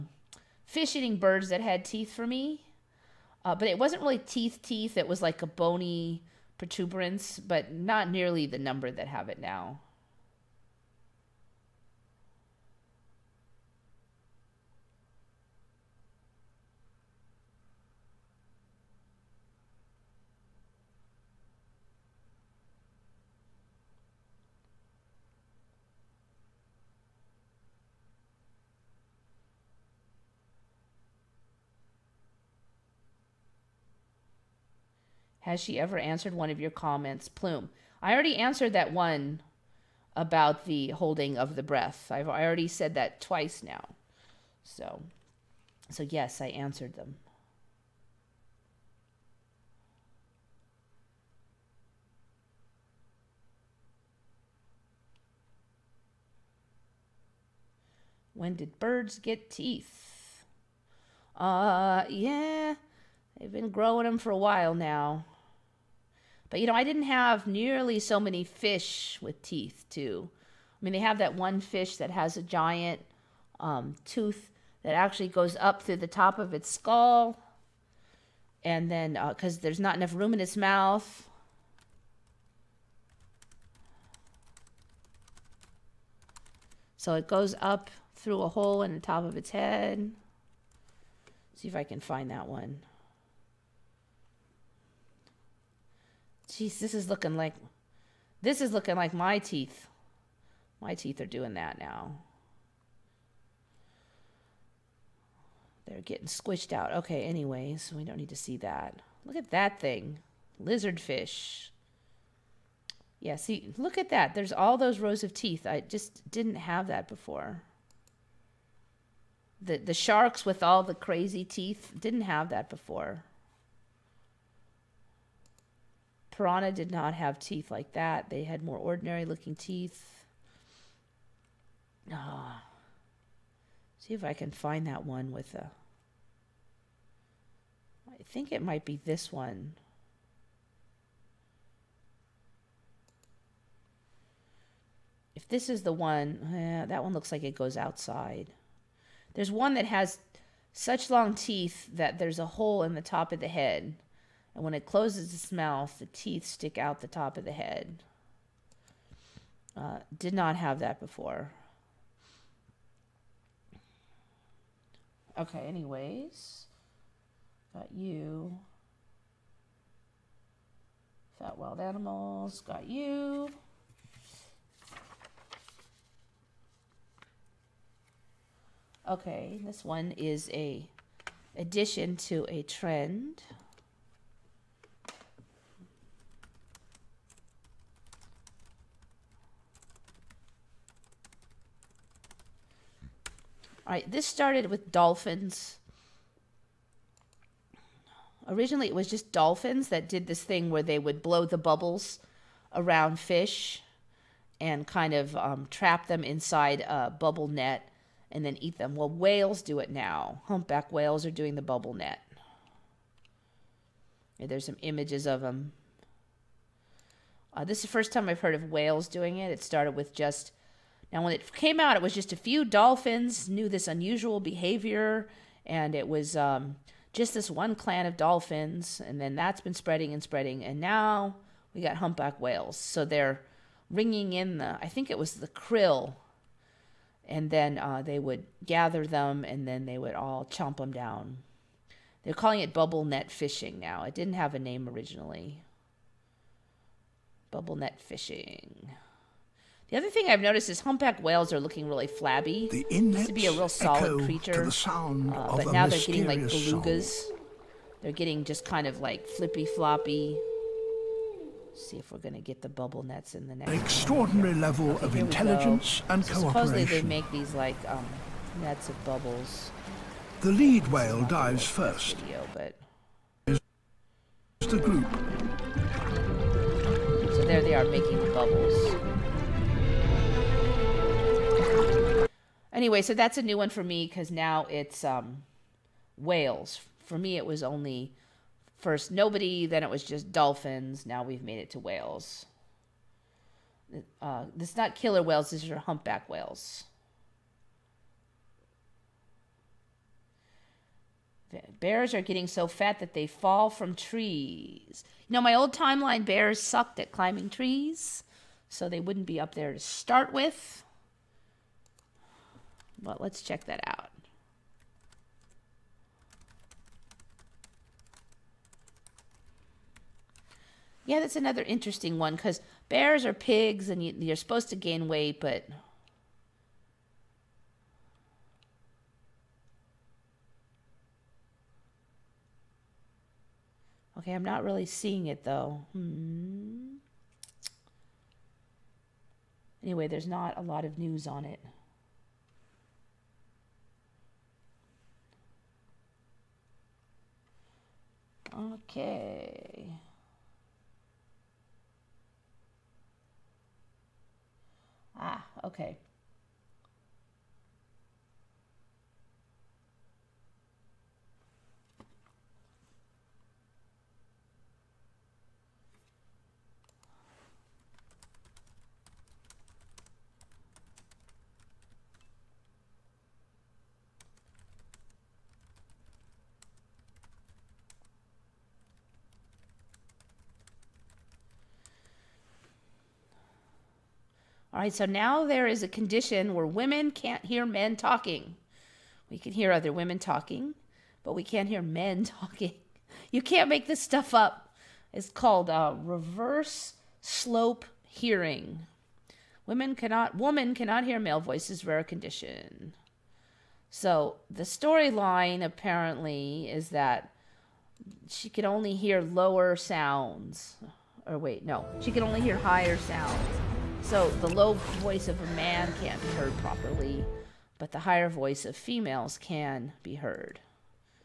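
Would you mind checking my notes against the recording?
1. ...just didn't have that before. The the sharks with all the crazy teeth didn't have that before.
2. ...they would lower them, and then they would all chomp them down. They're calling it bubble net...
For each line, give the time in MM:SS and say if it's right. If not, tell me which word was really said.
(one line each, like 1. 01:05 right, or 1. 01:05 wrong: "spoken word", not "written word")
1. 01:55 right
2. 03:58 wrong: "gather", not "lower".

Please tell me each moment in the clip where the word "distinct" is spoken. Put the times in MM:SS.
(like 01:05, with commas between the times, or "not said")
not said.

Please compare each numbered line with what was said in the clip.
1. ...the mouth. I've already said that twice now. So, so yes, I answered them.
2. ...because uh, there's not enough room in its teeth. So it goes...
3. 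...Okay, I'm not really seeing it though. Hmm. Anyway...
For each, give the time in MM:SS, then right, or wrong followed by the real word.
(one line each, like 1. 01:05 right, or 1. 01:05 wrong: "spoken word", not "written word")
1. 00:41 wrong: "breath", not "mouth"
2. 01:19 wrong: "mouth", not "teeth"
3. 05:34 right.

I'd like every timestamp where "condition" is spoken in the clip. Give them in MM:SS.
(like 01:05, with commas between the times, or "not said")
06:25, 06:42.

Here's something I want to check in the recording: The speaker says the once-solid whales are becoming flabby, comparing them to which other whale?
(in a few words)
Belugas.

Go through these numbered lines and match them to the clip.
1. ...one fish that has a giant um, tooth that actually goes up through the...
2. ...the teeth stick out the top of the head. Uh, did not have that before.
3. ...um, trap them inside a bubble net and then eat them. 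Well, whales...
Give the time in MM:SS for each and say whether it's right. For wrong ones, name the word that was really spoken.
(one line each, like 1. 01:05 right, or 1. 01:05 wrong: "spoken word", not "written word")
1. 01:11 right
2. 02:35 right
3. 03:25 right.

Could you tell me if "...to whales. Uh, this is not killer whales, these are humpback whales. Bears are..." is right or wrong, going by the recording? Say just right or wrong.
right.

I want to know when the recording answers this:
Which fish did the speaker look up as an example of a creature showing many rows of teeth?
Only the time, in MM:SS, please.
01:50.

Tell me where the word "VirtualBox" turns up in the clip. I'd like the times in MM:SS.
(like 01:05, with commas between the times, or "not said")
not said.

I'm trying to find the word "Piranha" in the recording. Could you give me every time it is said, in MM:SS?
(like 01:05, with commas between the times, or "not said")
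02:06.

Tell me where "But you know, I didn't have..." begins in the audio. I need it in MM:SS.
01:06.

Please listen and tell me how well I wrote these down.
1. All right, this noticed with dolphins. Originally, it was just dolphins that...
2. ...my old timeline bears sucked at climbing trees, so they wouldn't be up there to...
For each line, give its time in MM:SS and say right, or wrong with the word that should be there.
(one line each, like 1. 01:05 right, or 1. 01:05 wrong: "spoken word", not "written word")
1. 03:13 wrong: "started", not "noticed"
2. 05:05 right.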